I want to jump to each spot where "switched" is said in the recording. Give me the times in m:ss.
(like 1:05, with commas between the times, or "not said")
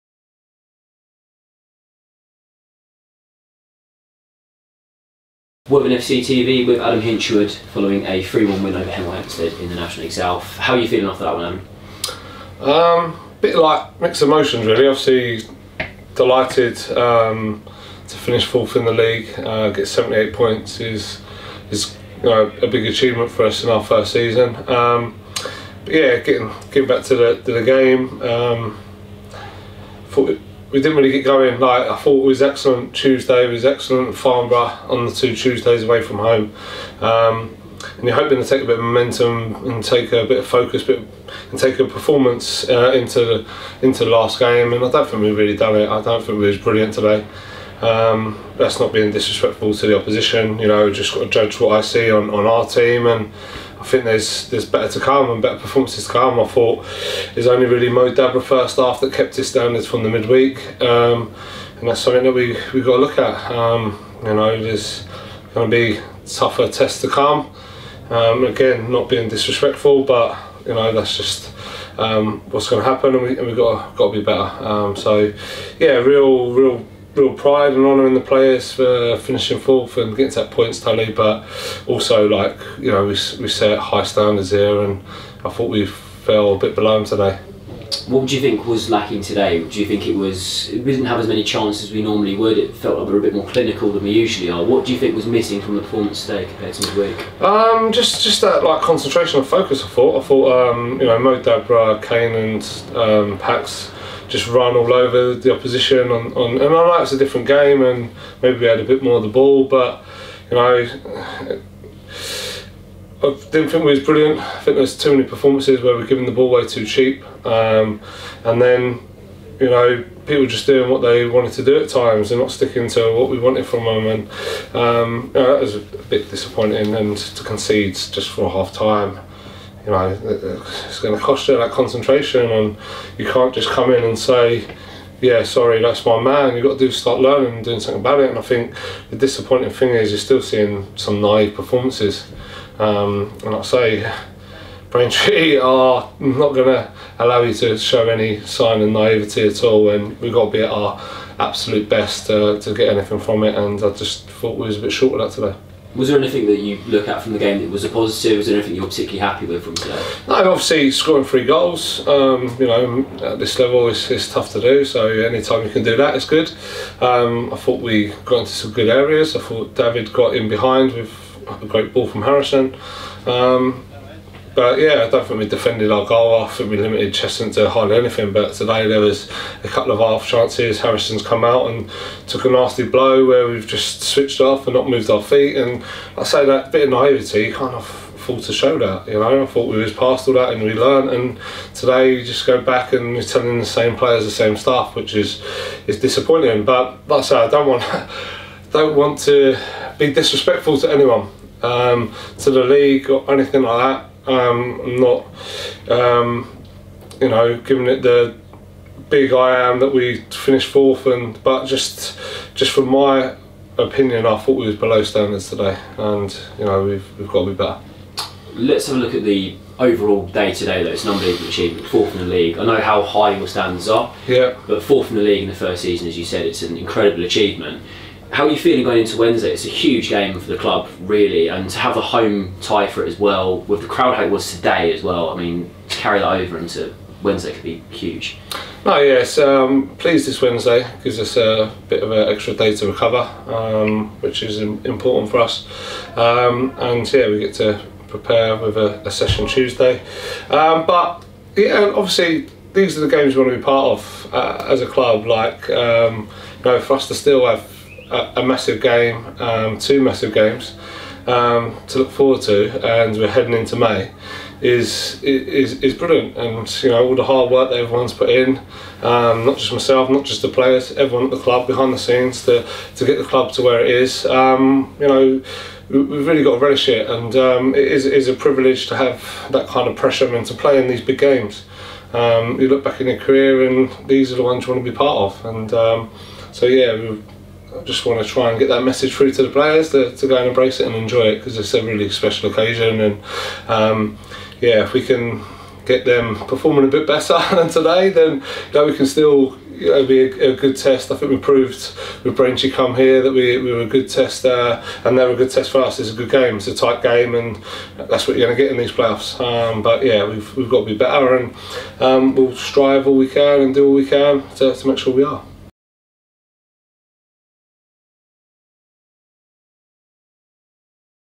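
3:04.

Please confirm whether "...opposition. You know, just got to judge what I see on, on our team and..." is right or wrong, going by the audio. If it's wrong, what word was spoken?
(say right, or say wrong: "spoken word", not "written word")
right.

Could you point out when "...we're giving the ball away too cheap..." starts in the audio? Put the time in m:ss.
1:55.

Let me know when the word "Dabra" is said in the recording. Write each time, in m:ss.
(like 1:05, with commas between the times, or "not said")
0:58, 1:41.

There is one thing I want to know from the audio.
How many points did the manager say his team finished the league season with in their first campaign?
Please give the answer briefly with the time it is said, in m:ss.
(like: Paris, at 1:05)
78, at 0:19.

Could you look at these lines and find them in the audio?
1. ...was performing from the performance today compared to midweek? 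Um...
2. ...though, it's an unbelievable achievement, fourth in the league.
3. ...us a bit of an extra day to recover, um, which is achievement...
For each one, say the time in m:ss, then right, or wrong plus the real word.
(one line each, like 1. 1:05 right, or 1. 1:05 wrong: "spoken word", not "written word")
1. 1:35 wrong: "missing", not "performing"
2. 3:40 right
3. 4:01 wrong: "important", not "achievement".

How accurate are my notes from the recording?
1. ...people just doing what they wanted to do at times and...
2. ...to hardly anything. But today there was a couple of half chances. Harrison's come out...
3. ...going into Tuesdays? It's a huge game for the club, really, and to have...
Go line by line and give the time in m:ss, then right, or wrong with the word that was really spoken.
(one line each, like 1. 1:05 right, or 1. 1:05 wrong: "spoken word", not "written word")
1. 2:00 right
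2. 2:57 right
3. 3:48 wrong: "Wednesday", not "Tuesdays".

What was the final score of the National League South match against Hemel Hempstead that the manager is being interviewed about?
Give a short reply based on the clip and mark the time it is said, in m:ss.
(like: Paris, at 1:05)
3-1, at 0:08.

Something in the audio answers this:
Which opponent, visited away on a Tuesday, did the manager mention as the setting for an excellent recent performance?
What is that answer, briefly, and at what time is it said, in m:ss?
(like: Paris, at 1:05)
Farnborough, at 0:34.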